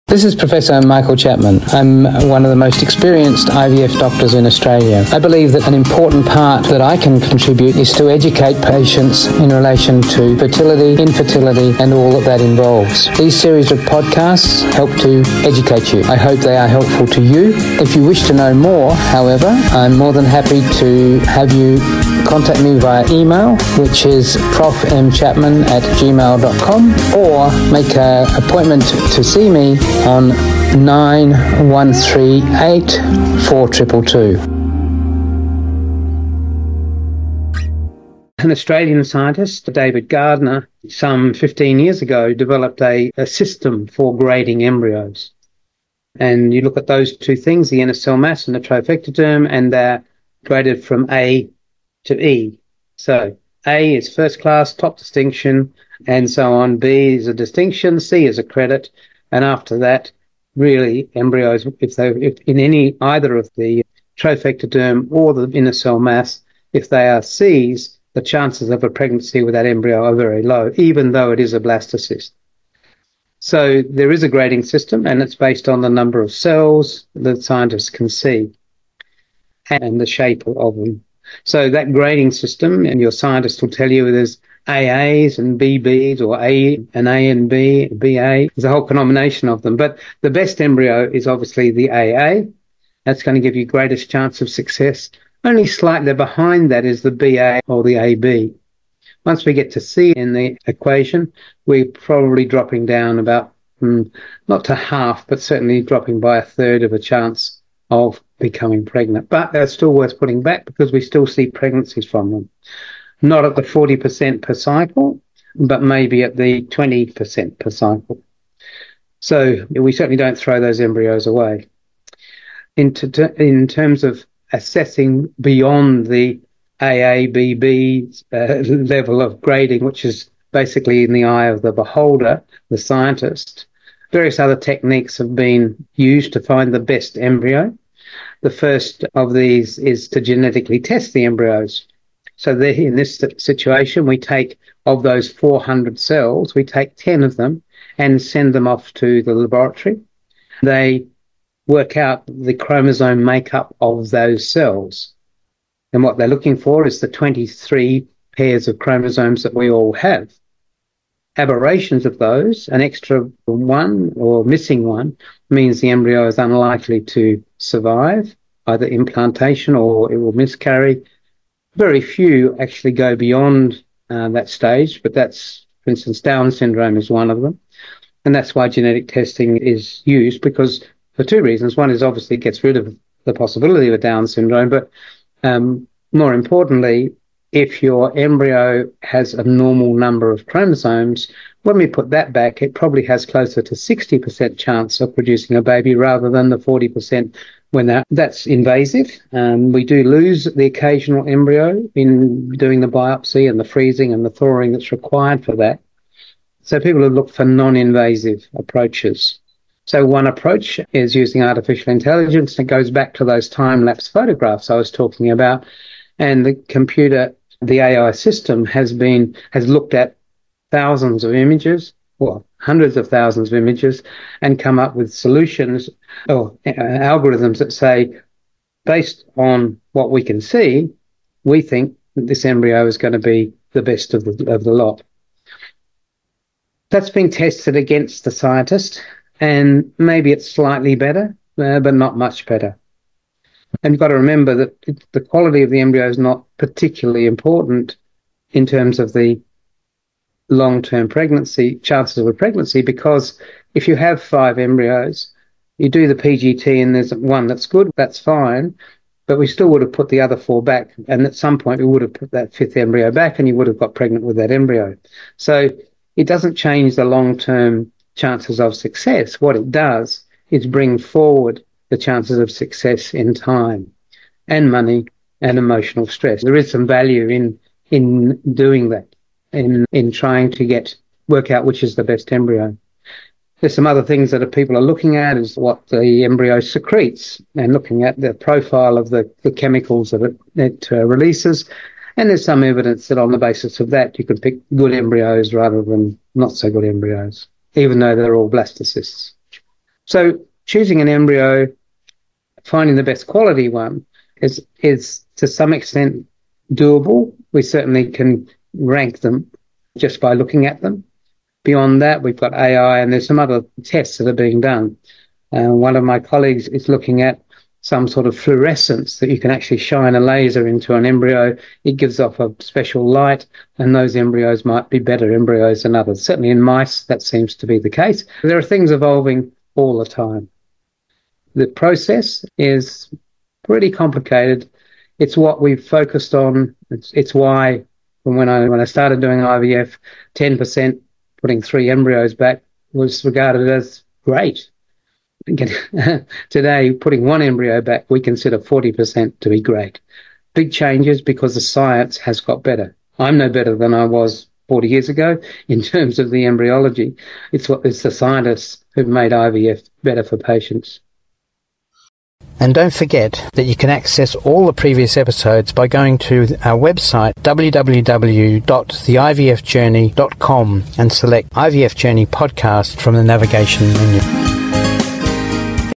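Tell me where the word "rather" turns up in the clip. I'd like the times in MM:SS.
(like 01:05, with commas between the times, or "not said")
03:15, 04:55.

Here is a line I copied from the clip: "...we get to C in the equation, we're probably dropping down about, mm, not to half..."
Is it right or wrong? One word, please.
right.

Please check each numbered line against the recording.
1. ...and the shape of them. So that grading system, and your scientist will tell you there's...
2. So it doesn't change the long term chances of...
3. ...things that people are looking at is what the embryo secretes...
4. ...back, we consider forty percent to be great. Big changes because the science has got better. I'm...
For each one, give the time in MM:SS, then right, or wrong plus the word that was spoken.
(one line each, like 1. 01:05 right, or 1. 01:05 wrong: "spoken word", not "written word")
1. 01:19 right
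2. 04:25 right
3. 04:44 right
4. 05:47 right.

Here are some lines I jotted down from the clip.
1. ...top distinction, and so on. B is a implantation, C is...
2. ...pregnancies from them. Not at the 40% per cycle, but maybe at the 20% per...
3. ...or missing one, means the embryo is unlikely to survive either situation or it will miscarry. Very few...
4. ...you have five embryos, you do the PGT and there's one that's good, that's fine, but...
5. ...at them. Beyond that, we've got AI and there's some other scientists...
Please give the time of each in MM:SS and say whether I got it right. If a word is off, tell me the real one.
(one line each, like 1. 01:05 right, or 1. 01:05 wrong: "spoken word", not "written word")
1. 00:54 wrong: "distinction", not "implantation"
2. 01:51 right
3. 02:44 wrong: "implantation", not "situation"
4. 04:13 right
5. 05:10 wrong: "tests", not "scientists".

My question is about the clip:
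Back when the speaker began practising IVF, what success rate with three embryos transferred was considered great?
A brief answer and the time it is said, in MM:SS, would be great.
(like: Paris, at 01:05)
10%, at 05:40.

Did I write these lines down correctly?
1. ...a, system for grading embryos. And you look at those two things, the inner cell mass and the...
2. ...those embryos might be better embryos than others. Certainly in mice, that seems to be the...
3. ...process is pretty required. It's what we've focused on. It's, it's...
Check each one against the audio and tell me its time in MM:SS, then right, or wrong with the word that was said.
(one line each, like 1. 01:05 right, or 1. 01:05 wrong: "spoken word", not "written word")
1. 00:43 right
2. 05:23 right
3. 05:31 wrong: "complicated", not "required".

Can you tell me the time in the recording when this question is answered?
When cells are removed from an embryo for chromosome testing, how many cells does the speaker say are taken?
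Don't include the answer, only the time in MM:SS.
02:26.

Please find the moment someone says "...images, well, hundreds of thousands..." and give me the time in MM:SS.
03:41.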